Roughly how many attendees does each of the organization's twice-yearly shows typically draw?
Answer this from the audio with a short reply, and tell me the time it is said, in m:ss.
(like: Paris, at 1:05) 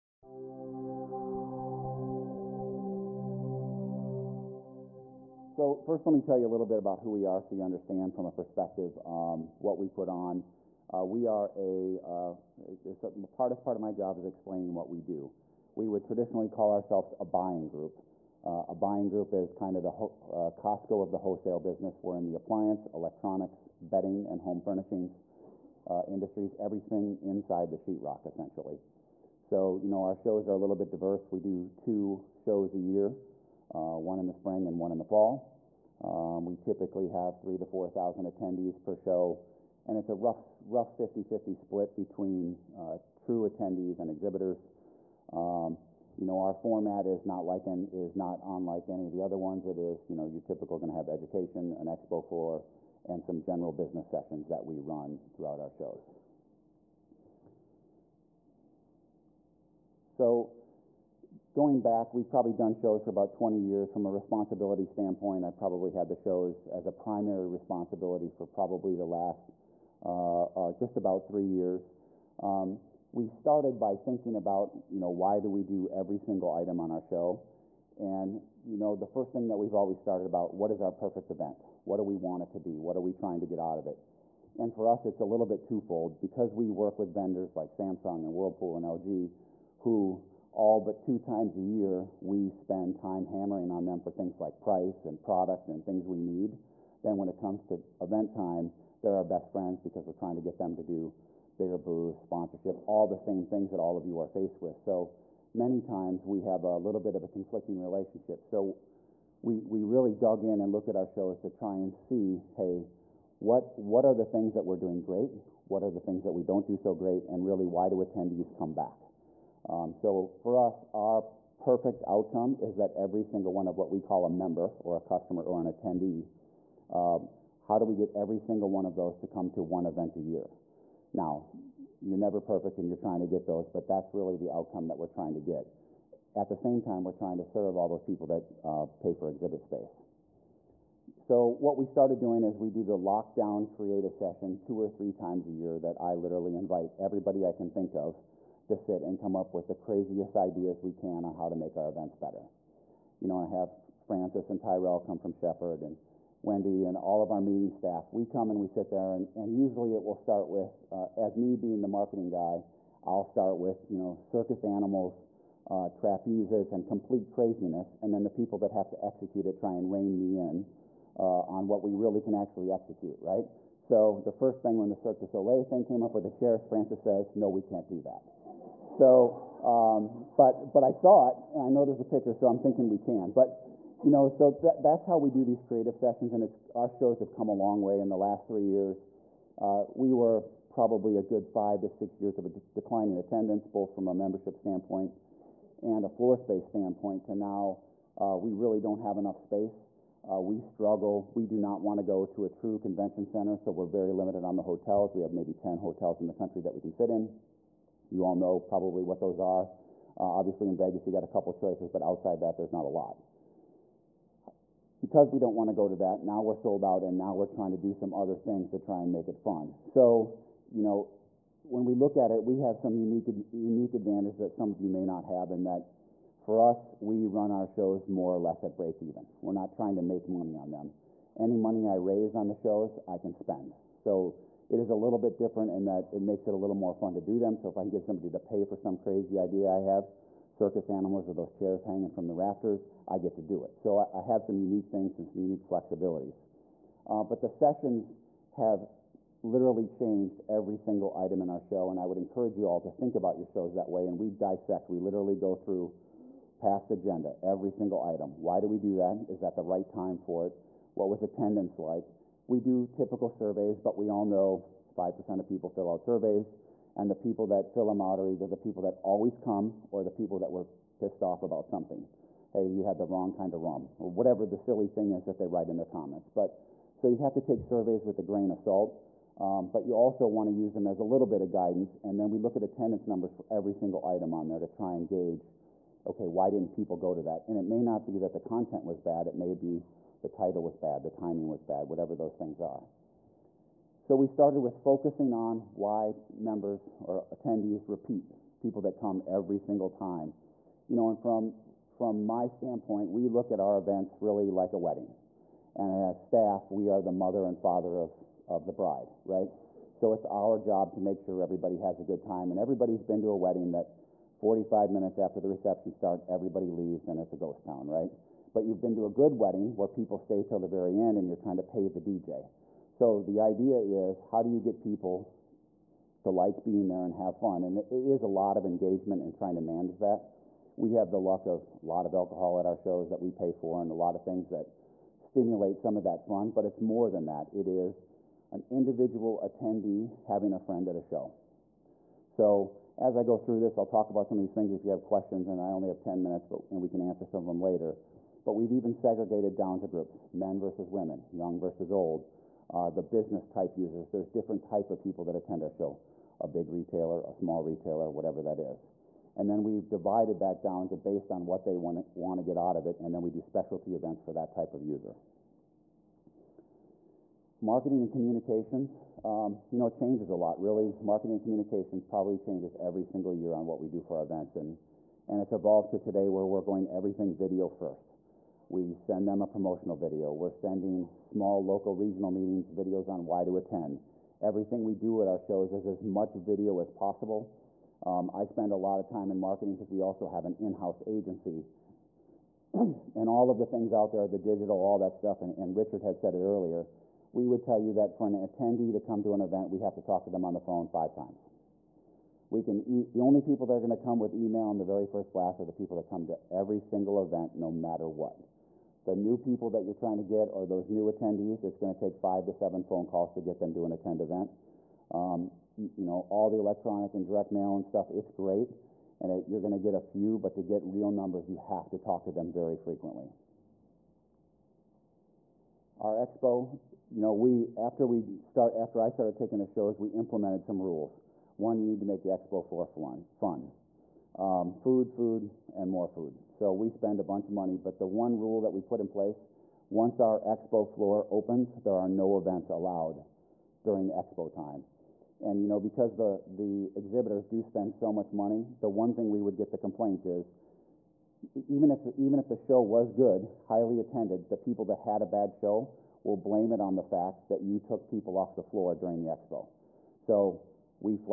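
3,000 to 4,000, at 0:37.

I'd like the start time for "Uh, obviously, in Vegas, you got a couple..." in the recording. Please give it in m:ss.
3:30.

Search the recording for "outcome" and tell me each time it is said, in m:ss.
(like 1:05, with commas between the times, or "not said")
2:02, 2:14.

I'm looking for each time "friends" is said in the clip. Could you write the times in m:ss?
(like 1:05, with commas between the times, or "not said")
1:39, 5:40.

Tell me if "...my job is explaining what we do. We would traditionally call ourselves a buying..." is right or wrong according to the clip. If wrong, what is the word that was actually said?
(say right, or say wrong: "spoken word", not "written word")
right.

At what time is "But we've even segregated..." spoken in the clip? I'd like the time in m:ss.
5:48.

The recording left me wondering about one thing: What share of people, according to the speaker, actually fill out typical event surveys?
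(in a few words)
5%.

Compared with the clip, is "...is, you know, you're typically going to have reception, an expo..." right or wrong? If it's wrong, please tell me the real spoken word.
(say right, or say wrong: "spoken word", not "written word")
wrong: "education", not "reception".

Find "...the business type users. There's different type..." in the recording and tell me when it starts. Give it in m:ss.
5:52.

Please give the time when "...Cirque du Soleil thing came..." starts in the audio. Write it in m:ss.
2:54.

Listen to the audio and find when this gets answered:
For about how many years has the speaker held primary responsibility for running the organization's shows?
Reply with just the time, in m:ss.
1:10.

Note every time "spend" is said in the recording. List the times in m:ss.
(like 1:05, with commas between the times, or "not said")
1:32, 3:53, 6:28, 7:16, 7:27.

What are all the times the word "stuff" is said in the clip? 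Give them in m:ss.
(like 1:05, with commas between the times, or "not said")
6:35, 6:57.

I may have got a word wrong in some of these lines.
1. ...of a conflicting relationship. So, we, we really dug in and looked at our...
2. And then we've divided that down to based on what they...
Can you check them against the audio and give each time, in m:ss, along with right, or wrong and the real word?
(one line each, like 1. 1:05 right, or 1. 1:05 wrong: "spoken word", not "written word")
1. 1:47 right
2. 5:59 right.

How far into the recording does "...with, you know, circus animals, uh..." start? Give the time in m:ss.
2:43.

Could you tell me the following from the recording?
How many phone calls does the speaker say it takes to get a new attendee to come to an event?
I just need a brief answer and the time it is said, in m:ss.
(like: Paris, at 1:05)
5 to 7, at 6:52.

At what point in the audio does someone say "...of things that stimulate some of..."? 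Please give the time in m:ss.
5:34.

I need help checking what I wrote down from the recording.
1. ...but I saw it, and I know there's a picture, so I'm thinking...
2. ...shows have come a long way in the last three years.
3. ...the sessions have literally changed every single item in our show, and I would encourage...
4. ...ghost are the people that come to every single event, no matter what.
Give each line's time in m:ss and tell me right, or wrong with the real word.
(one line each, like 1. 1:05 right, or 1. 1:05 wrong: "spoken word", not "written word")
1. 3:00 right
2. 3:06 right
3. 4:07 right
4. 6:45 wrong: "blast", not "ghost".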